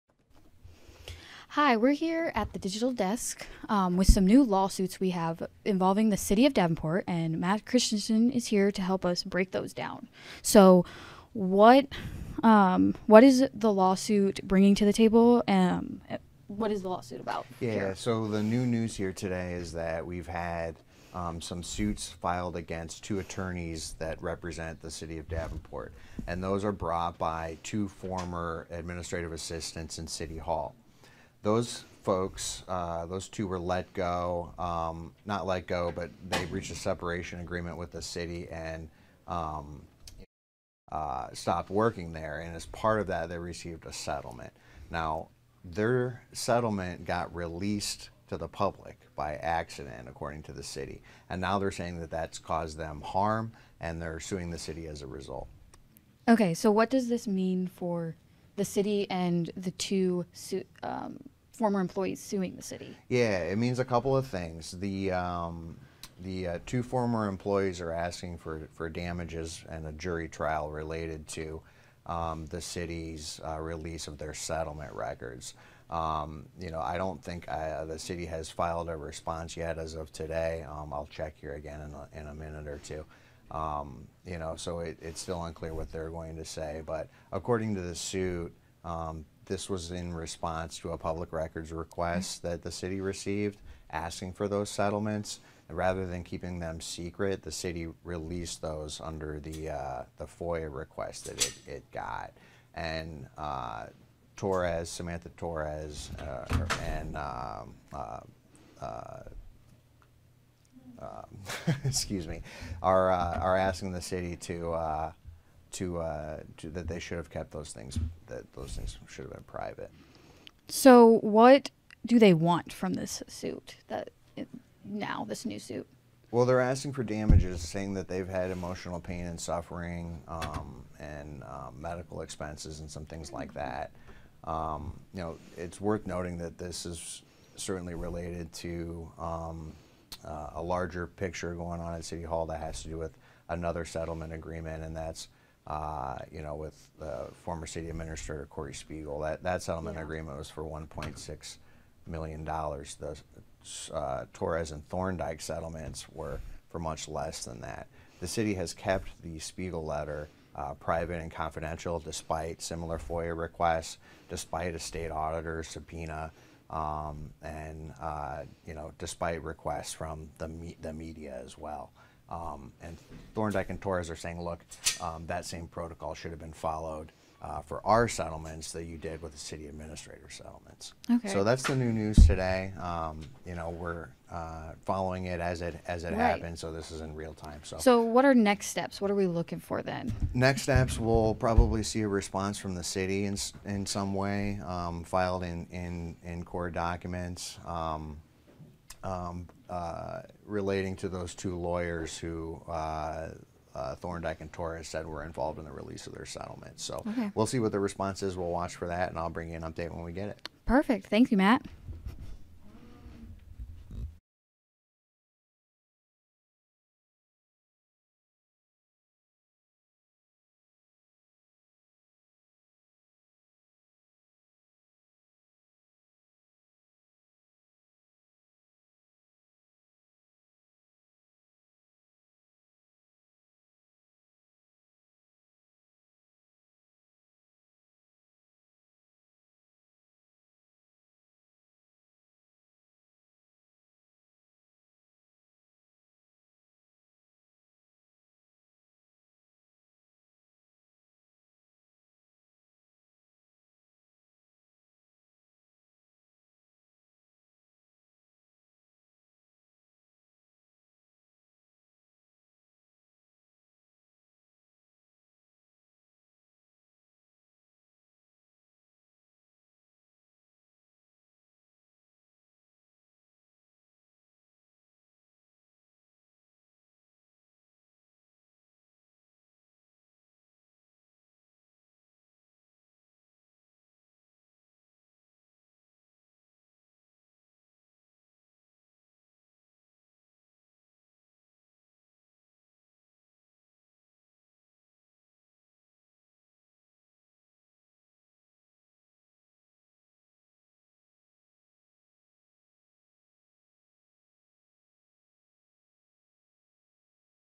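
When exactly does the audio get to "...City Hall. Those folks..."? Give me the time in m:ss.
0:30.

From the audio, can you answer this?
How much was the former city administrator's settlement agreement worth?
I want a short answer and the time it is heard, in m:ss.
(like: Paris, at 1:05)
$1.6 million, at 2:30.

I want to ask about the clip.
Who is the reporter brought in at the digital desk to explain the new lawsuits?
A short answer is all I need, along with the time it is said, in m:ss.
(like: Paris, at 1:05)
Matt Christensen, at 0:07.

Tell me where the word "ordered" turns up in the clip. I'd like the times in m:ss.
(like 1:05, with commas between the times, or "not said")
not said.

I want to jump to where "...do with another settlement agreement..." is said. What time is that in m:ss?
2:22.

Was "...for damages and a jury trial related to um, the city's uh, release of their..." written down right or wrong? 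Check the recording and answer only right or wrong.
right.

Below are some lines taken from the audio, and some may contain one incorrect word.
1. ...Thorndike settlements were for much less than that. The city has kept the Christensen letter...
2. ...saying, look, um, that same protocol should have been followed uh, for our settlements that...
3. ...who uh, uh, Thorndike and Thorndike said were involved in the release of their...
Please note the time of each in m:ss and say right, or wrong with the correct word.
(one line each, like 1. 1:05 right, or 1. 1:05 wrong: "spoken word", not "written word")
1. 2:34 wrong: "Spiegel", not "Christensen"
2. 2:54 right
3. 3:22 wrong: "Torres", not "Thorndike".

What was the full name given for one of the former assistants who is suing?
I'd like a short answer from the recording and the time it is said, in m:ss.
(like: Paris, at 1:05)
Samantha Torres, at 1:44.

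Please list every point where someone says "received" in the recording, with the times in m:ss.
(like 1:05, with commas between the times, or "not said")
0:43, 1:33.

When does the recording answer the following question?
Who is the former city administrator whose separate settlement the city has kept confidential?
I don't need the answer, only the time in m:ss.
2:28.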